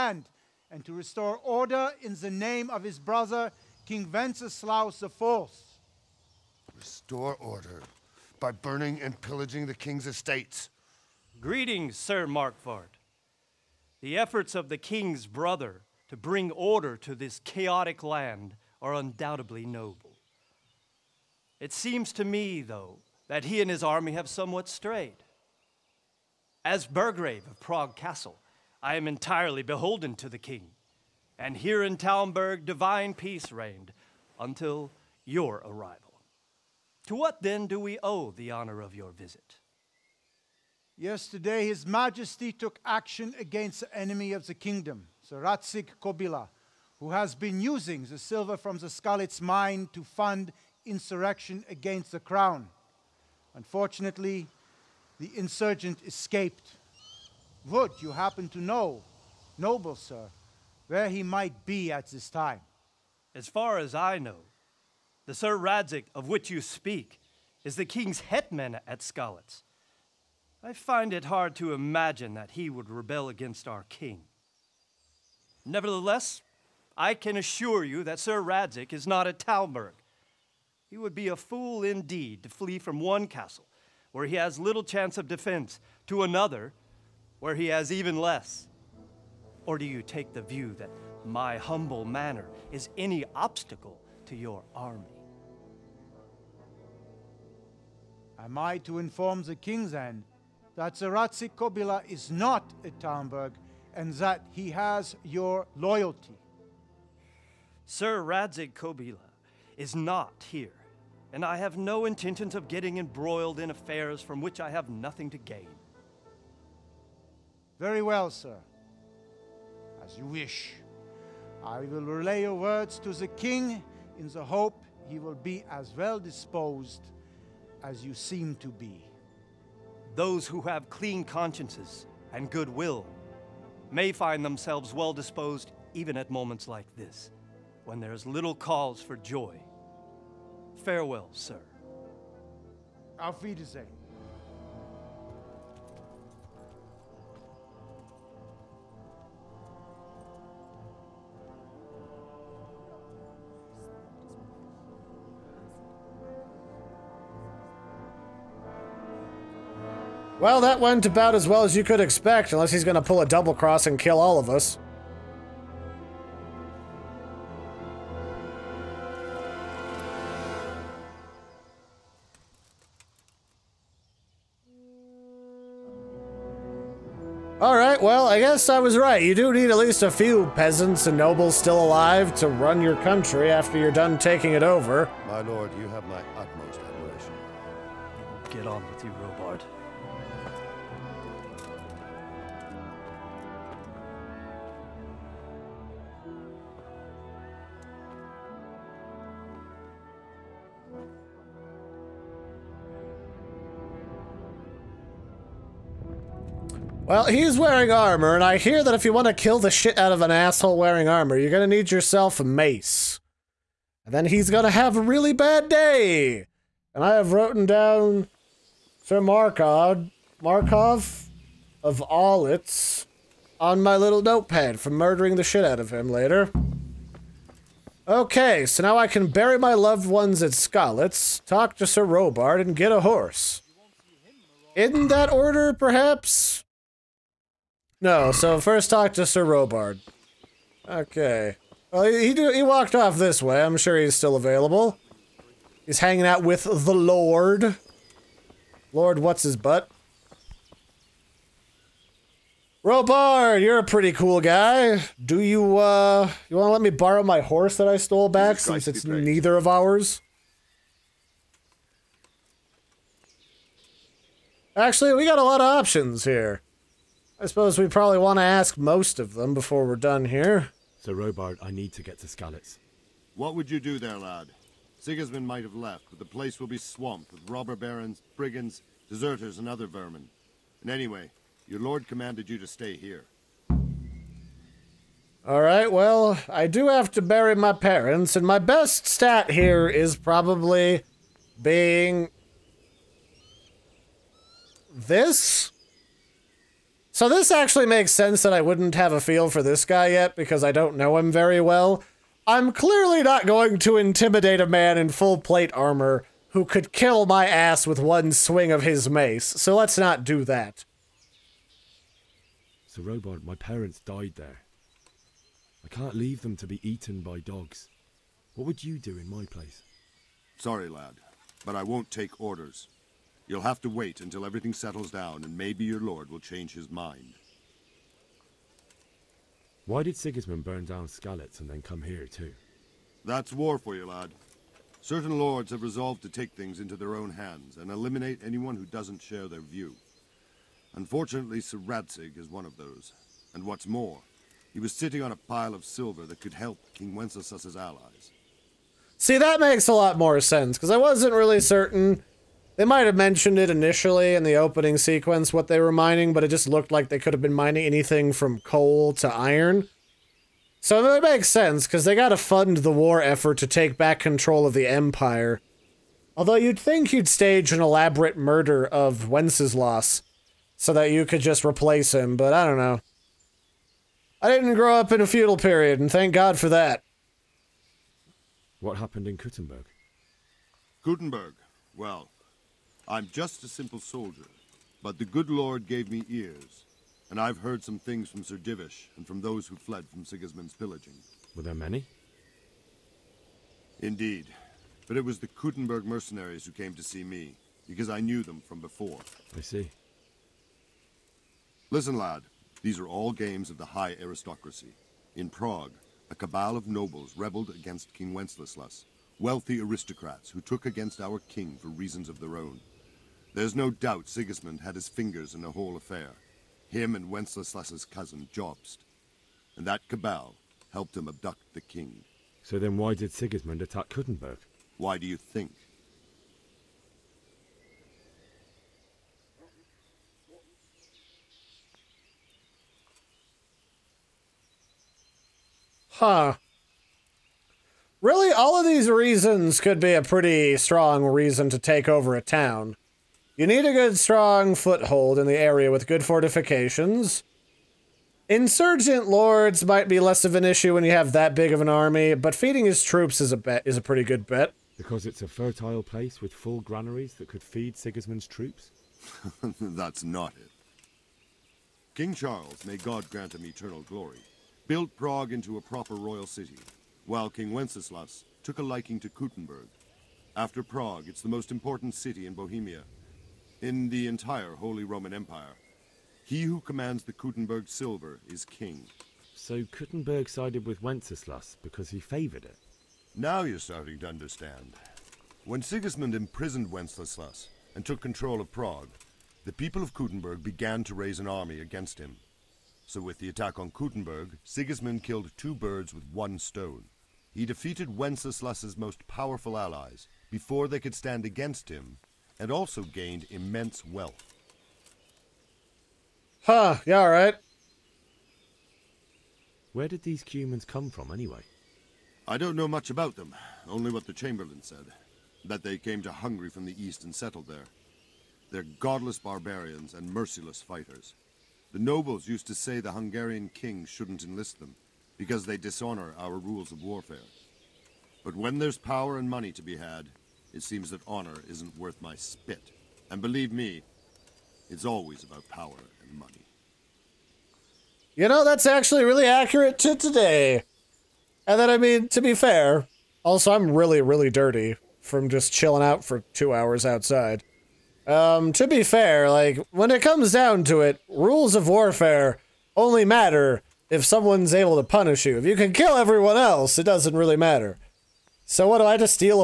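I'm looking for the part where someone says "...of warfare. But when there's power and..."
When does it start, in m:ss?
8:46.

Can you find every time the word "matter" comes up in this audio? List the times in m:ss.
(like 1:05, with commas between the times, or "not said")
9:13, 9:17.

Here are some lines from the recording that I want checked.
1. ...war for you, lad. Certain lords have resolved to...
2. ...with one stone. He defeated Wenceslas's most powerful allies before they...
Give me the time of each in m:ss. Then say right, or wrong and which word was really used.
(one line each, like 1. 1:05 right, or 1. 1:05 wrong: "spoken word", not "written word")
1. 5:33 right
2. 8:16 right.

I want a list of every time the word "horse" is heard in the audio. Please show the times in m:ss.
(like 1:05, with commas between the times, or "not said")
3:53, 4:17.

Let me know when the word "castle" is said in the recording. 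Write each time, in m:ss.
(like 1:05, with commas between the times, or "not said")
0:27, 1:23.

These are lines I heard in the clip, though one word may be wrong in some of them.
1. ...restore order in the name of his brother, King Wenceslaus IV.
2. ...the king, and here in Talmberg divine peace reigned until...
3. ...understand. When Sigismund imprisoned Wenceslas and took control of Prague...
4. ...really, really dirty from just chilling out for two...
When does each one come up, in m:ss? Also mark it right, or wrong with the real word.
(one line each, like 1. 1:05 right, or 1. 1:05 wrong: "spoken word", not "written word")
1. 0:00 right
2. 0:30 right
3. 8:04 right
4. 9:03 right.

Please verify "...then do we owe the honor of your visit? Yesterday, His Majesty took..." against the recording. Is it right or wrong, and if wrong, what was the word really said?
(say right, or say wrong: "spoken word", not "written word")
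right.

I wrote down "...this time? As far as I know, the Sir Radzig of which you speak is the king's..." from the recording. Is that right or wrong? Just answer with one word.
right.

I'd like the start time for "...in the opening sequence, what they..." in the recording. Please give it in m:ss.
5:54.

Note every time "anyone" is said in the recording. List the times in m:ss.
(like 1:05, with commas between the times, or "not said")
5:38.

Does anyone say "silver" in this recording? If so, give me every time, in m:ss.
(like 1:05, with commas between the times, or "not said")
0:48, 5:45, 7:57.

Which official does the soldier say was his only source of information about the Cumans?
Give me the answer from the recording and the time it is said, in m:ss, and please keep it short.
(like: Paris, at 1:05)
The Chamberlain, at 8:34.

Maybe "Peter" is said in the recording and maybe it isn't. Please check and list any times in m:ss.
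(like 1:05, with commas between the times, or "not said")
not said.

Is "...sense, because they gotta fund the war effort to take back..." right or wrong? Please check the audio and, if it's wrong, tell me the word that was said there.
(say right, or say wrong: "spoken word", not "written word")
right.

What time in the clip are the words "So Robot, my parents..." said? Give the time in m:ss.
5:12.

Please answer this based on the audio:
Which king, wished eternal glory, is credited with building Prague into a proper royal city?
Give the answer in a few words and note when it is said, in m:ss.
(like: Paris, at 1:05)
King Charles, at 7:42.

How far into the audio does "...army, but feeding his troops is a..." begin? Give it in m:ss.
7:31.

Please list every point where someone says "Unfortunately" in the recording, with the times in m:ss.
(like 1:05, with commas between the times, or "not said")
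0:53, 5:40.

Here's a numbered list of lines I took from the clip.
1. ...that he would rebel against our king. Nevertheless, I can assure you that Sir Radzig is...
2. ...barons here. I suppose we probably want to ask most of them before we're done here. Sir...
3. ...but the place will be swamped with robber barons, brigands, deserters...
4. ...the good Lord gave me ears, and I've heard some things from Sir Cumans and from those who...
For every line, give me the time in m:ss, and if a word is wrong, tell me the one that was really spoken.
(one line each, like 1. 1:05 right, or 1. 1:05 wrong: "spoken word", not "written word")
1. 1:12 right
2. 4:25 wrong: "options", not "barons"
3. 4:36 right
4. 6:25 wrong: "Divish", not "Cumans".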